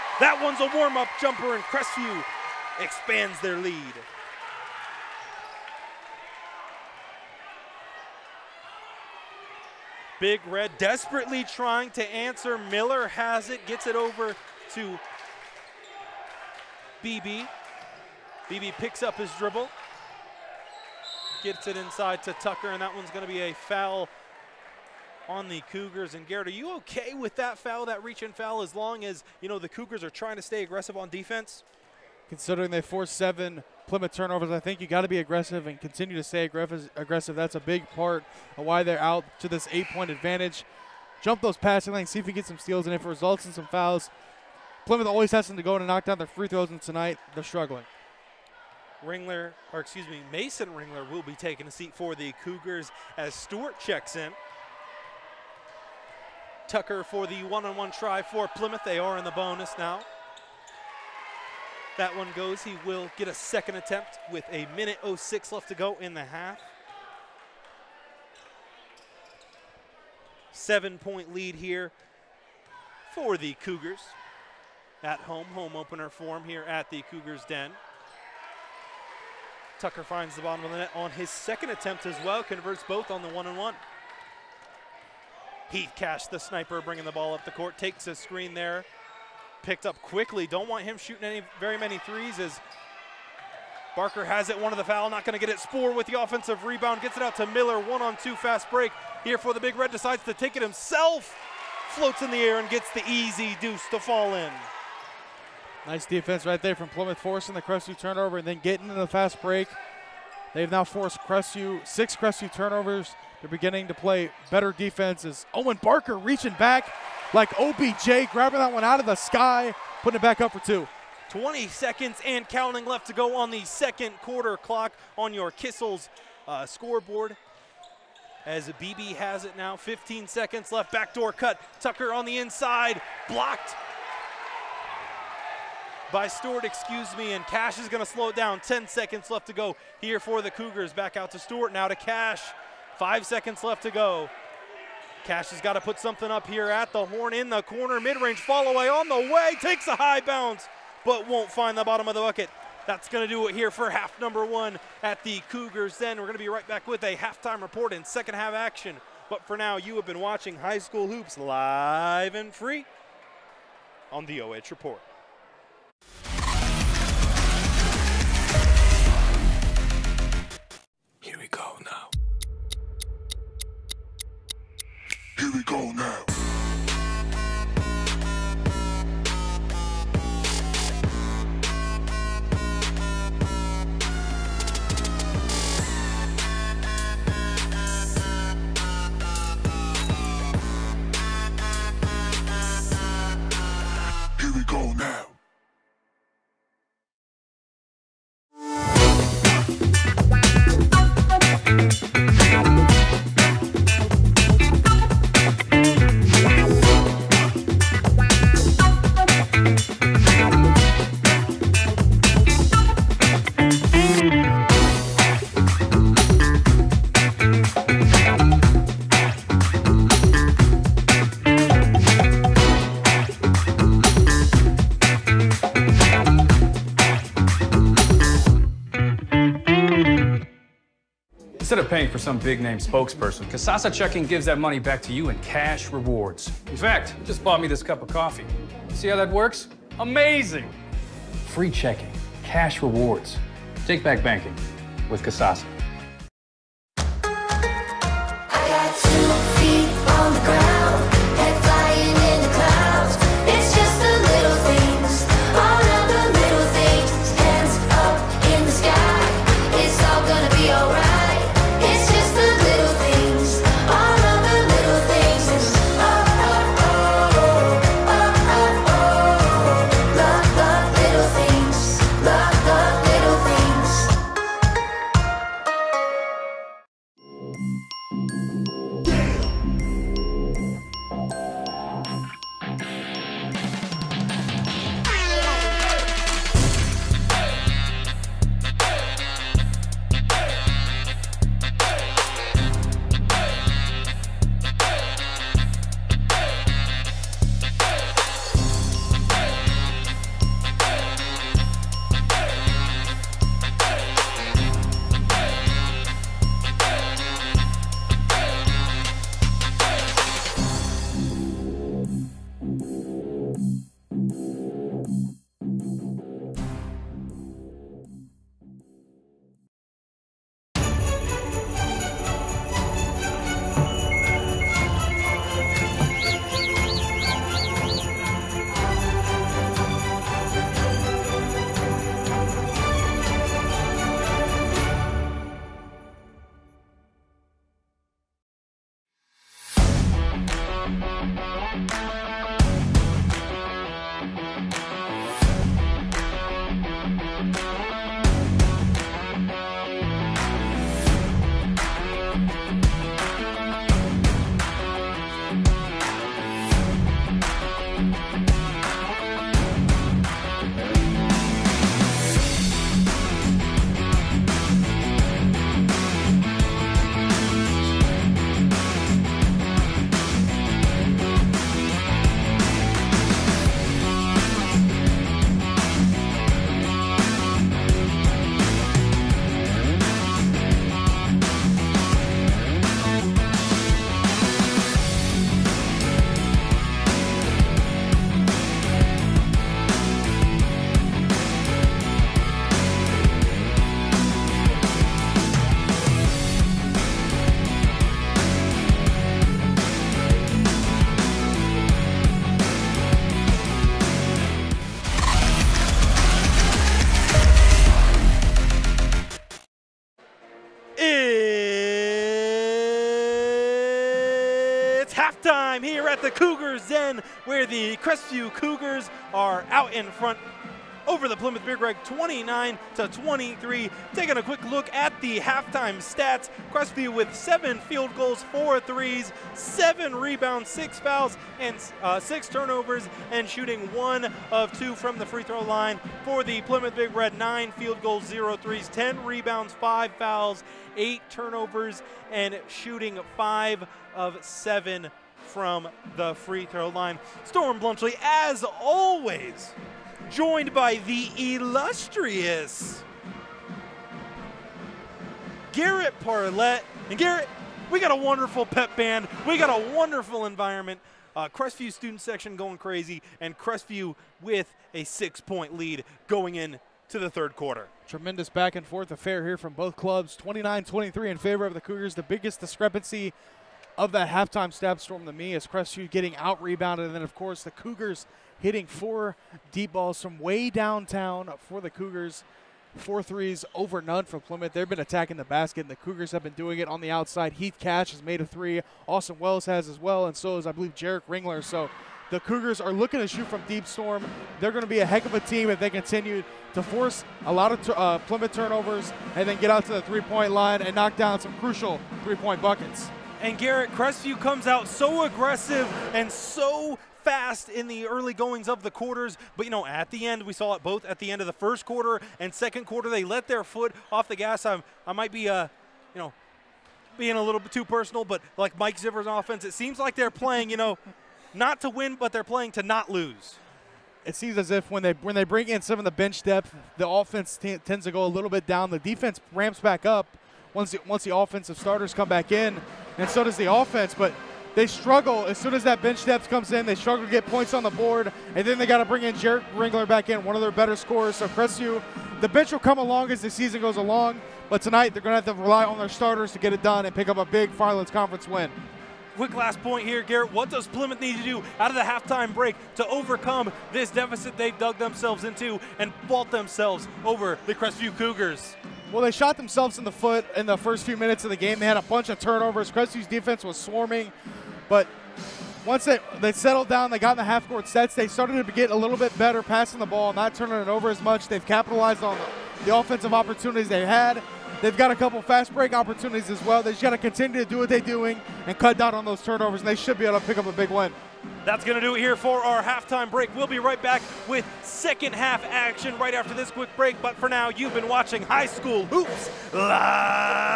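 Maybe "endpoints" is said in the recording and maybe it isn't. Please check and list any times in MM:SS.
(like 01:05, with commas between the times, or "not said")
not said.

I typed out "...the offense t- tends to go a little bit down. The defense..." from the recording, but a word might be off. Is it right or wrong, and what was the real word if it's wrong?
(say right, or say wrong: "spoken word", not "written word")
right.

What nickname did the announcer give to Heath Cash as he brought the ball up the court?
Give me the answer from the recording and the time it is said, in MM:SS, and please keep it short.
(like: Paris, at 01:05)
The sniper, at 01:26.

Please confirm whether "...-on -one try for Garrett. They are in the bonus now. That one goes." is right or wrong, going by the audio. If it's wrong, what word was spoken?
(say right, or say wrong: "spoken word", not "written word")
wrong: "Plymouth", not "Garrett".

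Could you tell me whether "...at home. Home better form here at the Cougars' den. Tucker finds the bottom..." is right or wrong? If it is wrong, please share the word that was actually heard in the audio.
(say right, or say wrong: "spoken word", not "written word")
wrong: "opener", not "better".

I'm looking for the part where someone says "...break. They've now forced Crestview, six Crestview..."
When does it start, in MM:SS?
01:49.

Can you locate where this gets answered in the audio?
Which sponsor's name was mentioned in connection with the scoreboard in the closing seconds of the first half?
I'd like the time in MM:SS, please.
02:05.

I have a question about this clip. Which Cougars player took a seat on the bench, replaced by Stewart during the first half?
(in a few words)
Mason Ringler.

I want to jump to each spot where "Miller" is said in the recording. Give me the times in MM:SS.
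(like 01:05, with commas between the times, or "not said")
00:12, 01:37.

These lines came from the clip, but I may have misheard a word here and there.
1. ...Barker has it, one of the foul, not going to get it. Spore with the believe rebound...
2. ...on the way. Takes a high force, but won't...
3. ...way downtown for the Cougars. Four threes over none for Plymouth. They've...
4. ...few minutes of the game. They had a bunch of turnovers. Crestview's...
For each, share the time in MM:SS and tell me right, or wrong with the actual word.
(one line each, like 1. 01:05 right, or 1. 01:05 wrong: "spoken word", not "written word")
1. 01:33 wrong: "offensive", not "believe"
2. 02:28 wrong: "bounce", not "force"
3. 08:00 right
4. 09:21 right.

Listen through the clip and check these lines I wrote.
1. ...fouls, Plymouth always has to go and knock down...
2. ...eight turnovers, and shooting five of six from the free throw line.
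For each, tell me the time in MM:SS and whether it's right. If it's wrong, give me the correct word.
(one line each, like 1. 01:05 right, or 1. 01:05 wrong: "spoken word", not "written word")
1. 00:43 right
2. 07:20 wrong: "seven", not "six".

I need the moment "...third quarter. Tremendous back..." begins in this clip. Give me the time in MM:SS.
07:47.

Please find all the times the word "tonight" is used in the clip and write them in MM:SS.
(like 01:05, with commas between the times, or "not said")
00:46, 09:04.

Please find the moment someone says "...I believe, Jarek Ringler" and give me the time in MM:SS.
08:10.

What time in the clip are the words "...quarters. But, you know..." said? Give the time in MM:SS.
08:28.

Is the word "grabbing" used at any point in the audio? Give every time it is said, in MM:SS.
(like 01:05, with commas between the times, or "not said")
01:58.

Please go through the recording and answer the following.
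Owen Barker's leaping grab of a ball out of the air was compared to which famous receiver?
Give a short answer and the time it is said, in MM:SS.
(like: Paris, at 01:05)
OBJ, at 01:57.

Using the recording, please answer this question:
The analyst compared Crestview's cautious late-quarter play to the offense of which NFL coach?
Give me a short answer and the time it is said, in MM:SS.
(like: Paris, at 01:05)
Mike Zimmer, at 08:38.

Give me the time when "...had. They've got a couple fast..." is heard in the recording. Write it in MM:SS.
09:34.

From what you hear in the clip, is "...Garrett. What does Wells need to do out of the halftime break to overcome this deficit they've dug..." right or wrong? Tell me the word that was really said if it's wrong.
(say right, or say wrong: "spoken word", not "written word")
wrong: "Plymouth", not "Wells".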